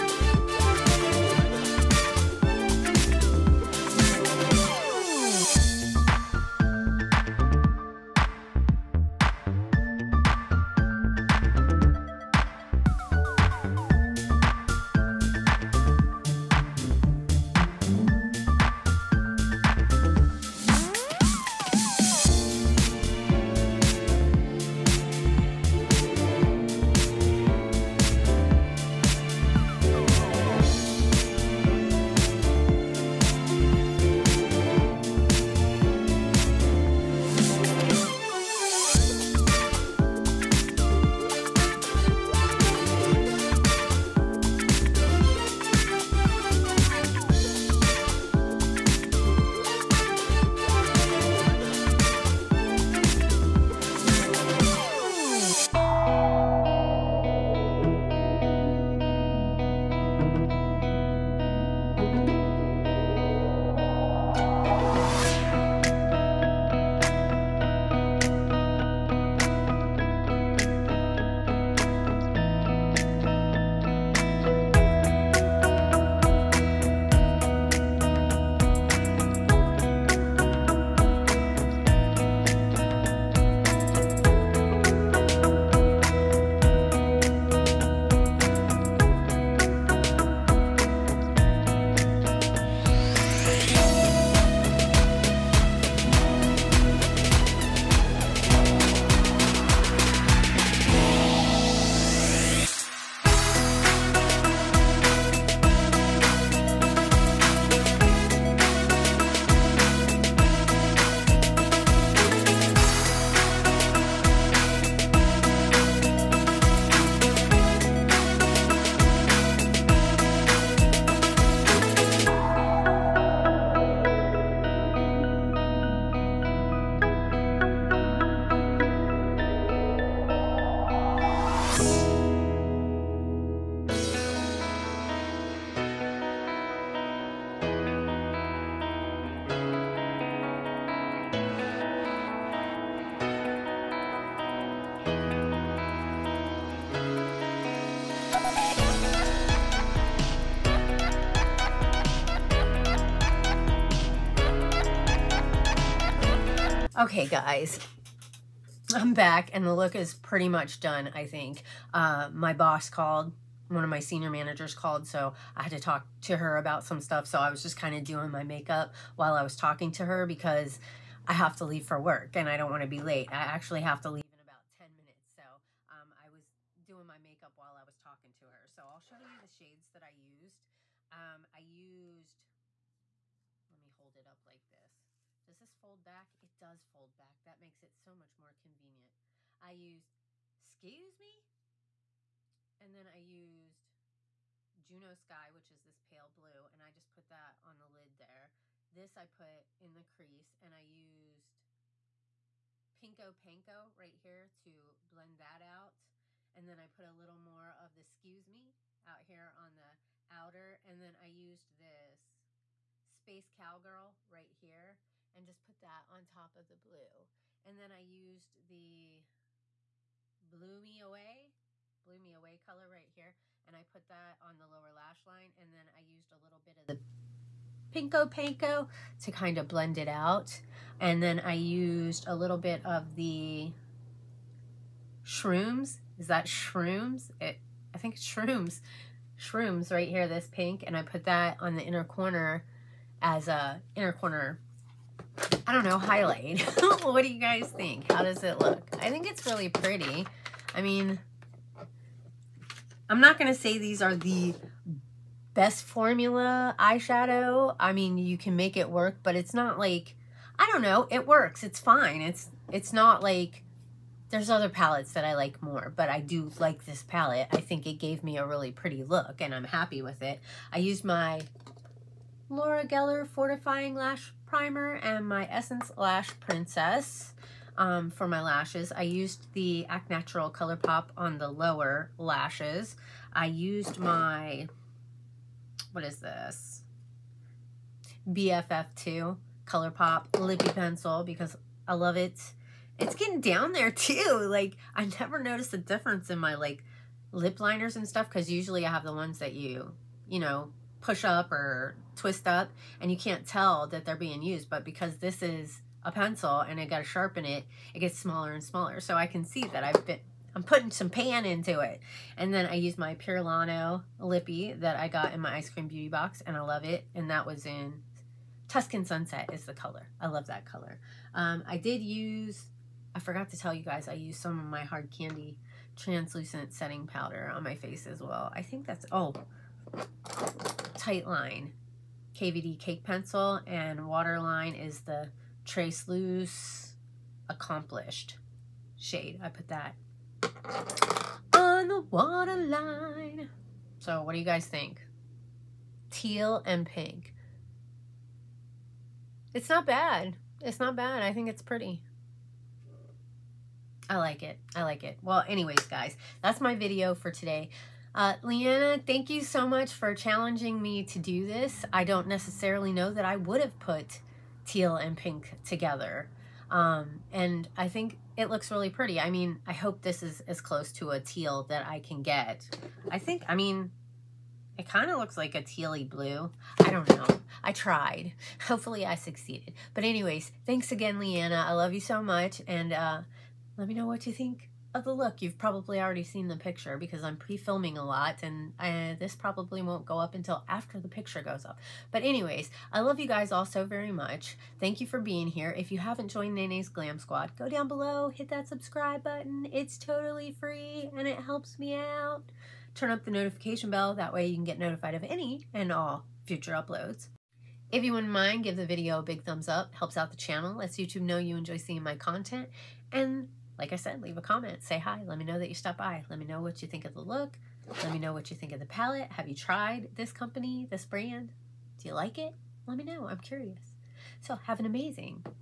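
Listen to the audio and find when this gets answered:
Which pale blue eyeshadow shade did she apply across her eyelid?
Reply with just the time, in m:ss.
3:14.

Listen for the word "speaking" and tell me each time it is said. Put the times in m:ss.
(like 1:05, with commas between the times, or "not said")
not said.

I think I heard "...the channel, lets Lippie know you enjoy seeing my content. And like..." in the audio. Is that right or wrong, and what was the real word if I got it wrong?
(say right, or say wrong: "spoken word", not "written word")
wrong: "YouTube", not "Lippie".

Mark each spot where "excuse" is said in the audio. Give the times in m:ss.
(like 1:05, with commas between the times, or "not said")
3:10, 3:28.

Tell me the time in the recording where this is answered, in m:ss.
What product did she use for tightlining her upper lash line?
5:32.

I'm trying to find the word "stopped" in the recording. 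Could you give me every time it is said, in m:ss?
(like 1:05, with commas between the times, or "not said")
6:55.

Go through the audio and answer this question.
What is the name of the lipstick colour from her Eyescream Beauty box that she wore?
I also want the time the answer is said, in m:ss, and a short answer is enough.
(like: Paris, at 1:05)
Tuscan Sunset, at 5:18.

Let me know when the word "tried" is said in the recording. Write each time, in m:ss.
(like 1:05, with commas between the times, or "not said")
6:17, 6:59.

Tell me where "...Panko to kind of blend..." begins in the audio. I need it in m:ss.
3:48.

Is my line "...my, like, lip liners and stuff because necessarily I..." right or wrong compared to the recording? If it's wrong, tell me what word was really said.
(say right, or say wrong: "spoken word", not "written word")
wrong: "usually", not "necessarily".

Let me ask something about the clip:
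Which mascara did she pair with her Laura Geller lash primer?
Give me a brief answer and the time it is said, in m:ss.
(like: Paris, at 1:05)
Essence Lash Princess, at 4:35.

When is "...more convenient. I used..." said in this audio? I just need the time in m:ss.
3:08.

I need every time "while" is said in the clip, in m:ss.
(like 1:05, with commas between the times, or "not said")
2:49, 2:57.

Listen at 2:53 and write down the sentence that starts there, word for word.
I actually have to leave in about 10 minutes.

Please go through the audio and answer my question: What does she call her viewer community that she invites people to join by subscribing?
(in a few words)
Nene's Glam Squad.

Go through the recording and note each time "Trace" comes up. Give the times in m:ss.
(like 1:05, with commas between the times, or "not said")
5:35.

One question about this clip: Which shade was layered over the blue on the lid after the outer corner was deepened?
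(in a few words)
Space Cowgirl.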